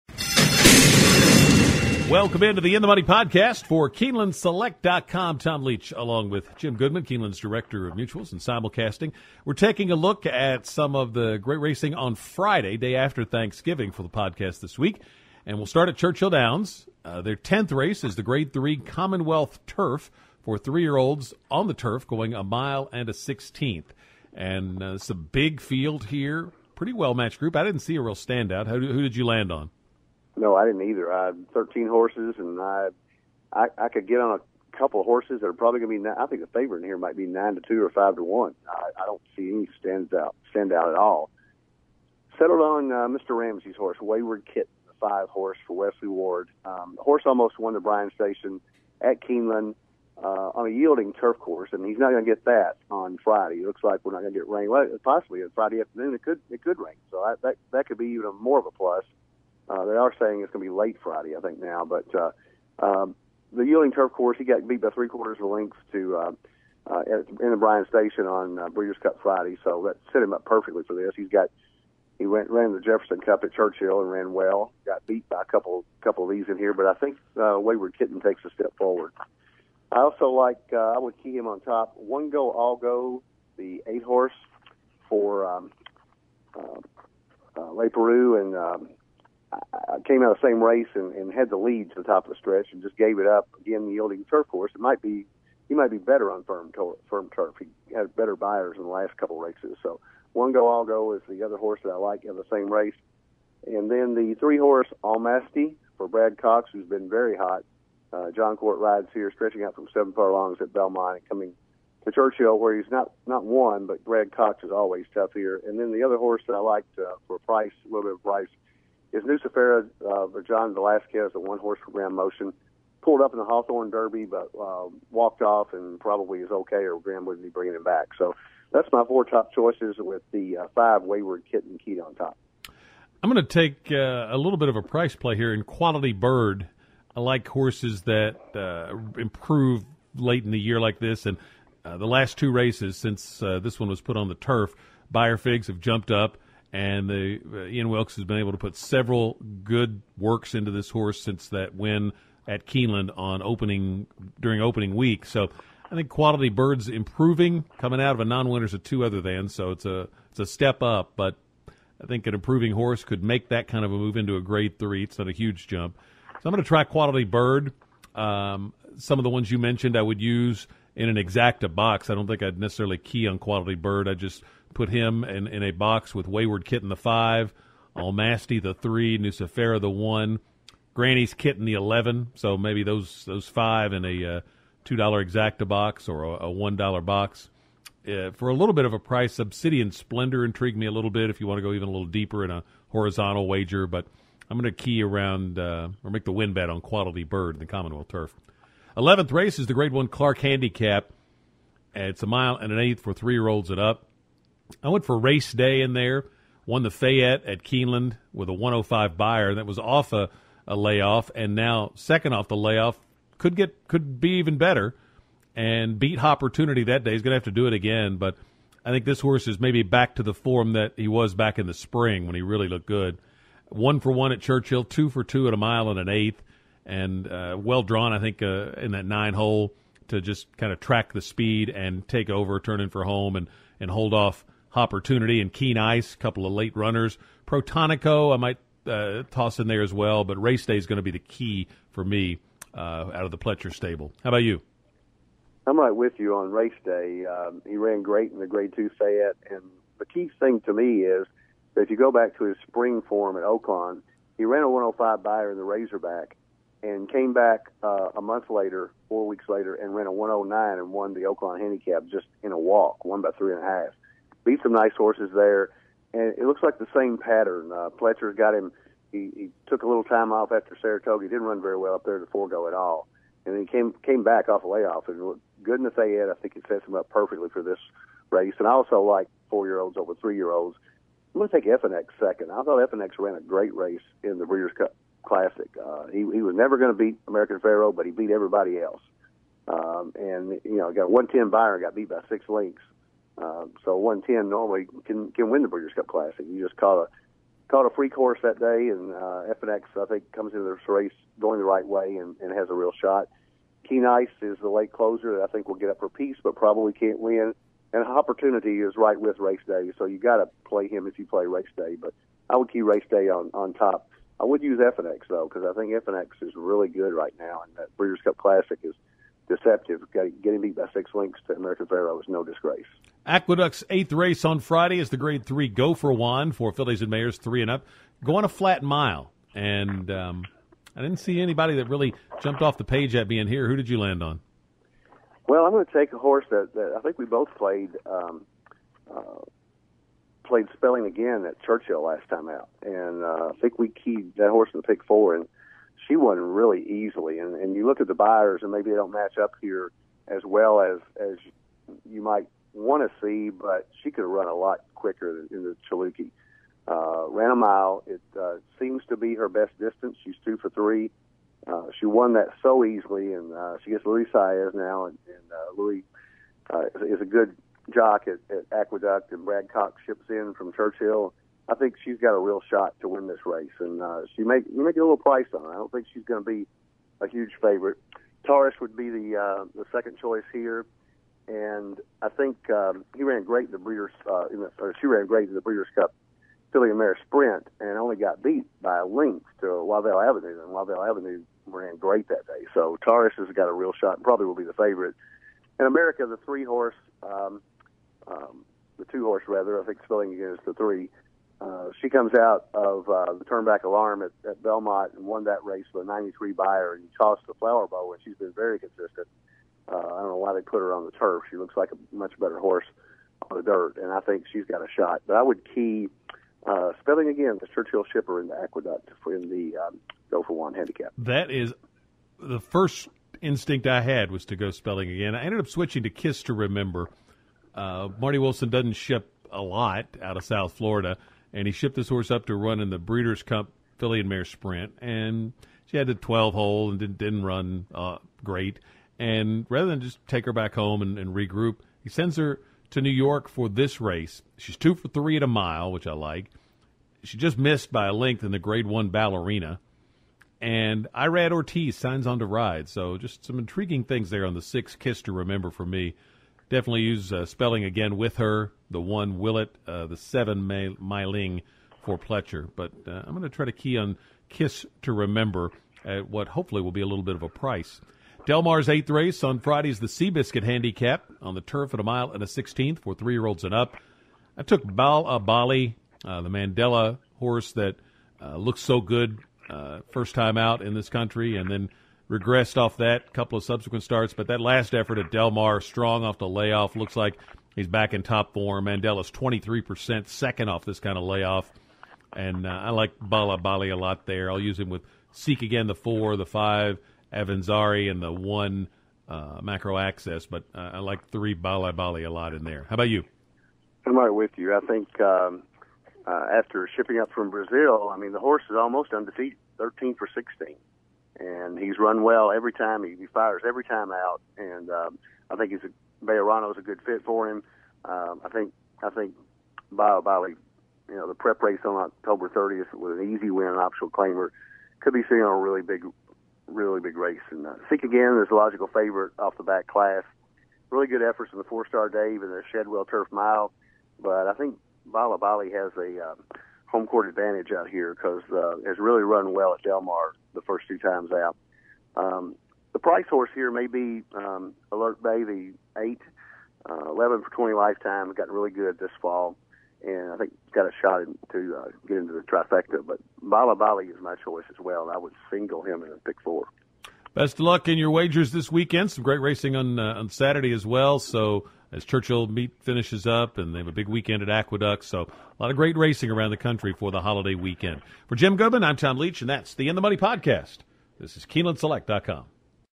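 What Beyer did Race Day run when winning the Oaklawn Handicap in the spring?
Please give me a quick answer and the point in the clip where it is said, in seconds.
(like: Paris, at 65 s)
109, at 260 s.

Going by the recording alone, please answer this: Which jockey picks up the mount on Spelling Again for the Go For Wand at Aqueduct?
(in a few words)
Luis Saez.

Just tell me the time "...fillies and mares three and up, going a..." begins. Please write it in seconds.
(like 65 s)
326 s.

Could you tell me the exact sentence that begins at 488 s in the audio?
Mandella's 23%, second off this kind of layoff.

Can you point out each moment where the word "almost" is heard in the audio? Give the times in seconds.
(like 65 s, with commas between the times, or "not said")
47 s, 508 s.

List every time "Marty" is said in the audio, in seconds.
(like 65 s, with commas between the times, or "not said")
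428 s.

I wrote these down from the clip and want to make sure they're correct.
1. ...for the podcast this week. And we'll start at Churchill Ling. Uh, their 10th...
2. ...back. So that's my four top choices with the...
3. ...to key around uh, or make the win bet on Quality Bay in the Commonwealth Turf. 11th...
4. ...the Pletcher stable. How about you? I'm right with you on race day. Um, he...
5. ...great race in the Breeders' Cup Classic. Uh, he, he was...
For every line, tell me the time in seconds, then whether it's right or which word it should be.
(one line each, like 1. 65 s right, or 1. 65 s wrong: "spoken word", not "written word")
1. 13 s wrong: "Downs", not "Ling"
2. 127 s right
3. 194 s wrong: "Bird", not "Bay"
4. 243 s right
5. 283 s right.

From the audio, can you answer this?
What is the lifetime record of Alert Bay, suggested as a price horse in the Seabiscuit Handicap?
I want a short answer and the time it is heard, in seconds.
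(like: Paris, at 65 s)
11 for 20, at 547 s.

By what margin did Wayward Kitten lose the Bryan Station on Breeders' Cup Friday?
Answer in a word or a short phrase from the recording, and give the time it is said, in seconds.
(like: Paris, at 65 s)
three quarters of a length, at 64 s.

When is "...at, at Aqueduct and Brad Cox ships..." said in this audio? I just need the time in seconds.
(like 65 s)
368 s.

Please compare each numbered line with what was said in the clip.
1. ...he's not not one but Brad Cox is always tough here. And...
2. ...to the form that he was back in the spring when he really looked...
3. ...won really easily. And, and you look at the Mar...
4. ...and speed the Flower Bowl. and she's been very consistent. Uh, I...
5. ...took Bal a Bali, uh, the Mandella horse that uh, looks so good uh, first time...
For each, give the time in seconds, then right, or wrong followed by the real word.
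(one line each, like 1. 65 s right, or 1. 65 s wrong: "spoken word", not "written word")
1. 112 s right
2. 220 s right
3. 346 s wrong: "Beyers", not "Mar"
4. 406 s wrong: "tossed", not "speed"
5. 474 s right.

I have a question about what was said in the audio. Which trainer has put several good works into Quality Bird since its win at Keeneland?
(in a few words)
Ian Wilkes.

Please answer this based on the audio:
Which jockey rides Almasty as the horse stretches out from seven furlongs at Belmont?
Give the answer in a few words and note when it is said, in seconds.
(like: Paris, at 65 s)
Jon Court, at 108 s.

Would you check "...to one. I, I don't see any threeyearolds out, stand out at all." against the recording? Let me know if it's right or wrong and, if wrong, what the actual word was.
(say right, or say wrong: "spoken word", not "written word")
wrong: "stands", not "threeyearolds".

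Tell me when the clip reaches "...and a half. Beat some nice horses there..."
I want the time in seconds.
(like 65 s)
263 s.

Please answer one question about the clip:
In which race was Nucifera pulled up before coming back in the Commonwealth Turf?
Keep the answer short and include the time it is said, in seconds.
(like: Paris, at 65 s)
Hawthorne Derby, at 123 s.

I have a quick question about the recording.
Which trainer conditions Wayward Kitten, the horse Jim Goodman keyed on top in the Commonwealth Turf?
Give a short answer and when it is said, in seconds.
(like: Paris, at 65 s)
Wesley Ward, at 45 s.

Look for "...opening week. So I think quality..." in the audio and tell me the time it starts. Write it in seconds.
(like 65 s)
154 s.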